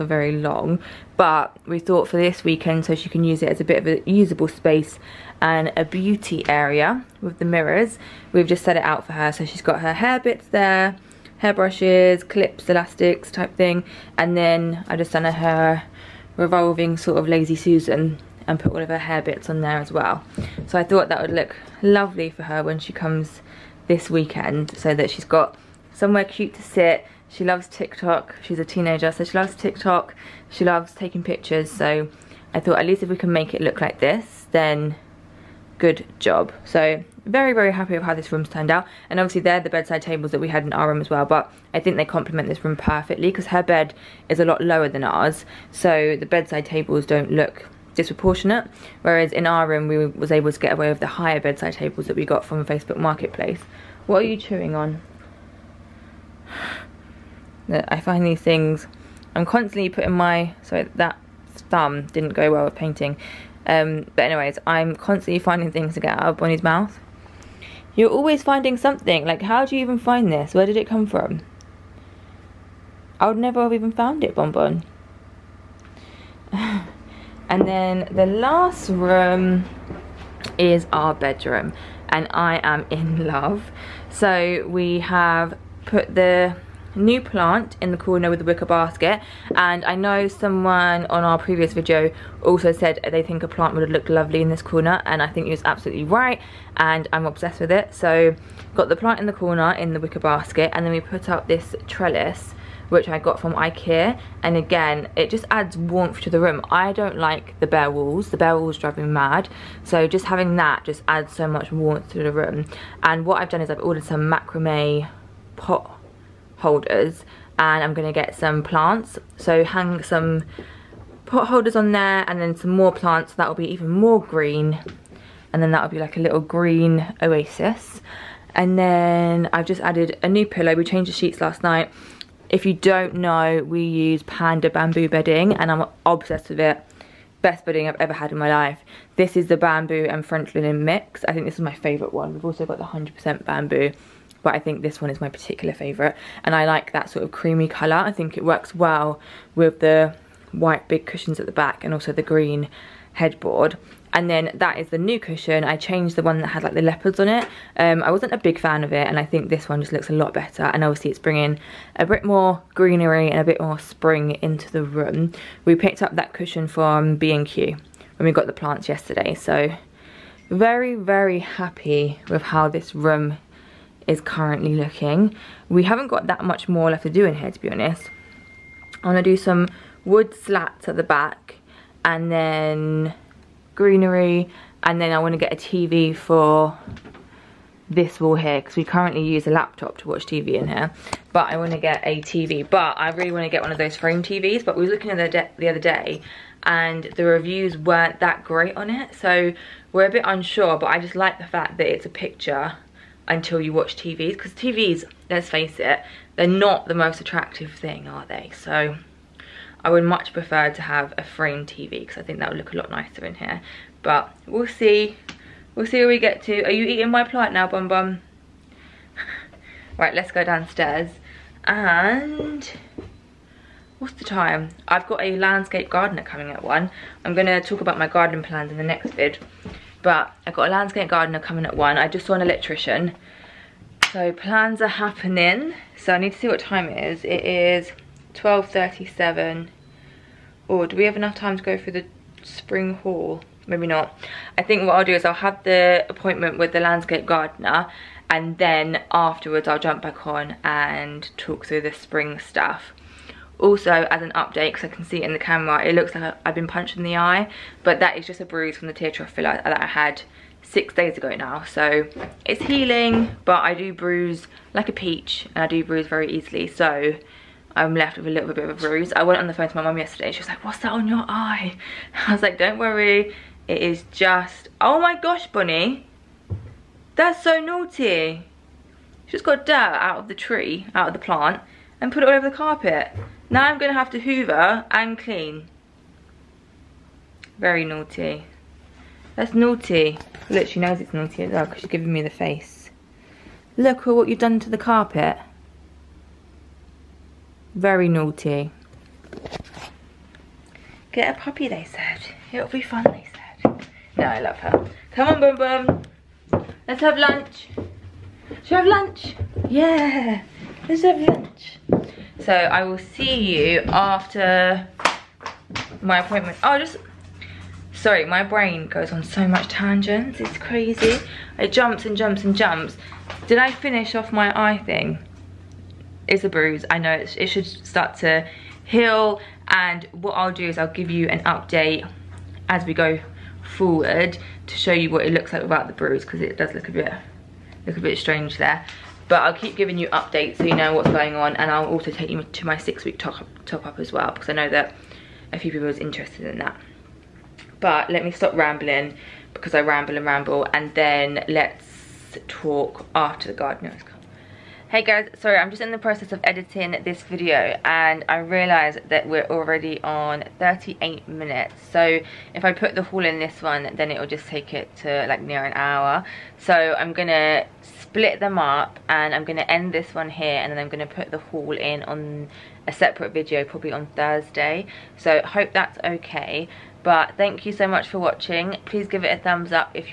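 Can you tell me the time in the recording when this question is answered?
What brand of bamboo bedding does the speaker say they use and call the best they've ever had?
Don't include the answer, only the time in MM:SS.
02:14.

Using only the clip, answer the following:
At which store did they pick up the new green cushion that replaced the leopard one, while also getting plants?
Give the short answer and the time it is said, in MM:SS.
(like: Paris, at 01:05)
B&Q, at 02:47.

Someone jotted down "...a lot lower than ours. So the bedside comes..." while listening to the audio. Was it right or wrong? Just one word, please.
wrong.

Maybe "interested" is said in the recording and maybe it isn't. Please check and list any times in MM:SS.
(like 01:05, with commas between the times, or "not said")
05:45.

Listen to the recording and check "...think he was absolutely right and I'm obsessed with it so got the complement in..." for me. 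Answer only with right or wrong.
wrong.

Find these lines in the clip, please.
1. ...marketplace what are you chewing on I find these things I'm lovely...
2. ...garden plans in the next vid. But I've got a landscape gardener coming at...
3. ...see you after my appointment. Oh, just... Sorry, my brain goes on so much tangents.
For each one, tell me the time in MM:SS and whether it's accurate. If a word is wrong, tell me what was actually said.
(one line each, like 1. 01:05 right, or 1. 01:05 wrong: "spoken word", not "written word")
1. 00:52 wrong: "constantly", not "lovely"
2. 03:48 right
3. 05:12 right.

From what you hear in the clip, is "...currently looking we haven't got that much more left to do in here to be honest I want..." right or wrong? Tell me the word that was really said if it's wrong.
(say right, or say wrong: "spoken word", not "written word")
right.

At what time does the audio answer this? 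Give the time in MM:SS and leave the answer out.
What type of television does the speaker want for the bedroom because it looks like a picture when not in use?
03:13.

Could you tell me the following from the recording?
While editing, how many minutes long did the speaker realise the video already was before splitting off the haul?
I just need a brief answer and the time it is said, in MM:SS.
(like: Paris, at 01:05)
38, at 06:00.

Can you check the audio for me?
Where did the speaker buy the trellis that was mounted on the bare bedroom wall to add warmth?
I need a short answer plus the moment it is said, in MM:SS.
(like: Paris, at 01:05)
Ikea, at 01:43.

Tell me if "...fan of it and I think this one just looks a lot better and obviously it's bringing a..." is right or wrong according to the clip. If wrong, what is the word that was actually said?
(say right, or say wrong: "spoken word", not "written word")
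right.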